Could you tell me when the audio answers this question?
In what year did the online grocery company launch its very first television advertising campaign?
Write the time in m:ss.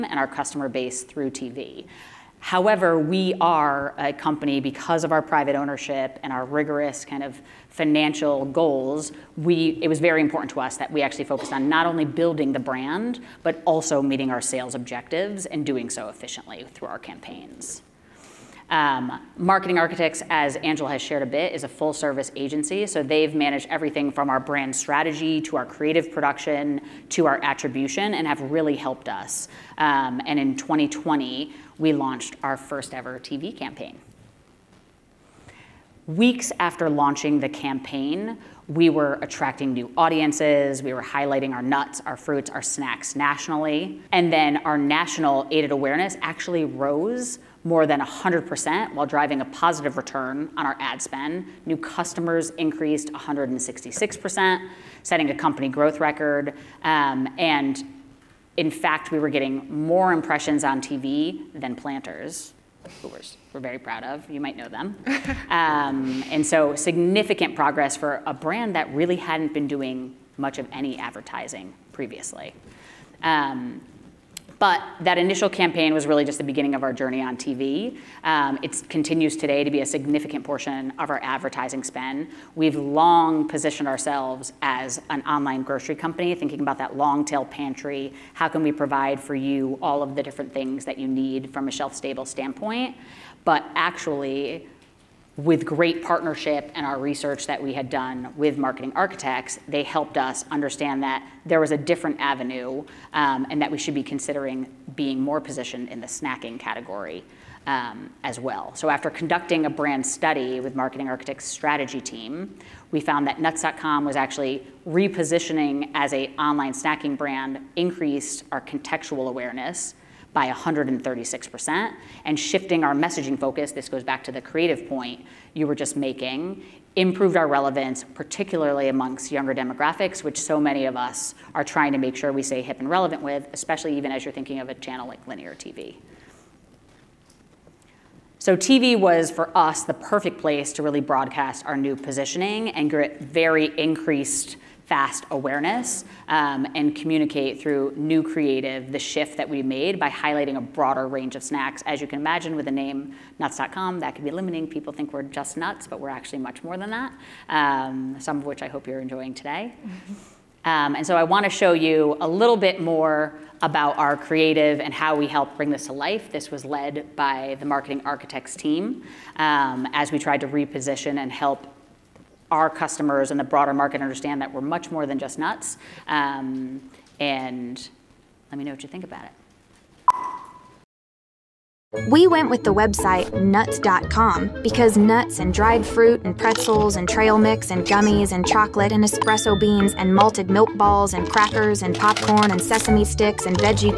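0:30.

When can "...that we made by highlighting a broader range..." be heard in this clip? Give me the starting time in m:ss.
2:29.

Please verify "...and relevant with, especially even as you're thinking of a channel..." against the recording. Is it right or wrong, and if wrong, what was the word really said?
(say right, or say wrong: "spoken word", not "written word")
right.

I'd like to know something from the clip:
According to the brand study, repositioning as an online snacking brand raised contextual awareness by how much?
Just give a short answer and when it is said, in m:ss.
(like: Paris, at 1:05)
136%, at 2:00.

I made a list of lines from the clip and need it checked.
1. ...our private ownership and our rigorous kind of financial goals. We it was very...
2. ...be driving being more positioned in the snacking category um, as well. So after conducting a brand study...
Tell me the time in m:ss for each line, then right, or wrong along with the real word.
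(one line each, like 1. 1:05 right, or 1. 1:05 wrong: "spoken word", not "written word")
1. 0:05 right
2. 1:43 wrong: "considering", not "driving".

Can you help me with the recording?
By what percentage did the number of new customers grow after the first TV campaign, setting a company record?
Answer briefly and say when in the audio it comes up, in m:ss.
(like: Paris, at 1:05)
166%, at 0:53.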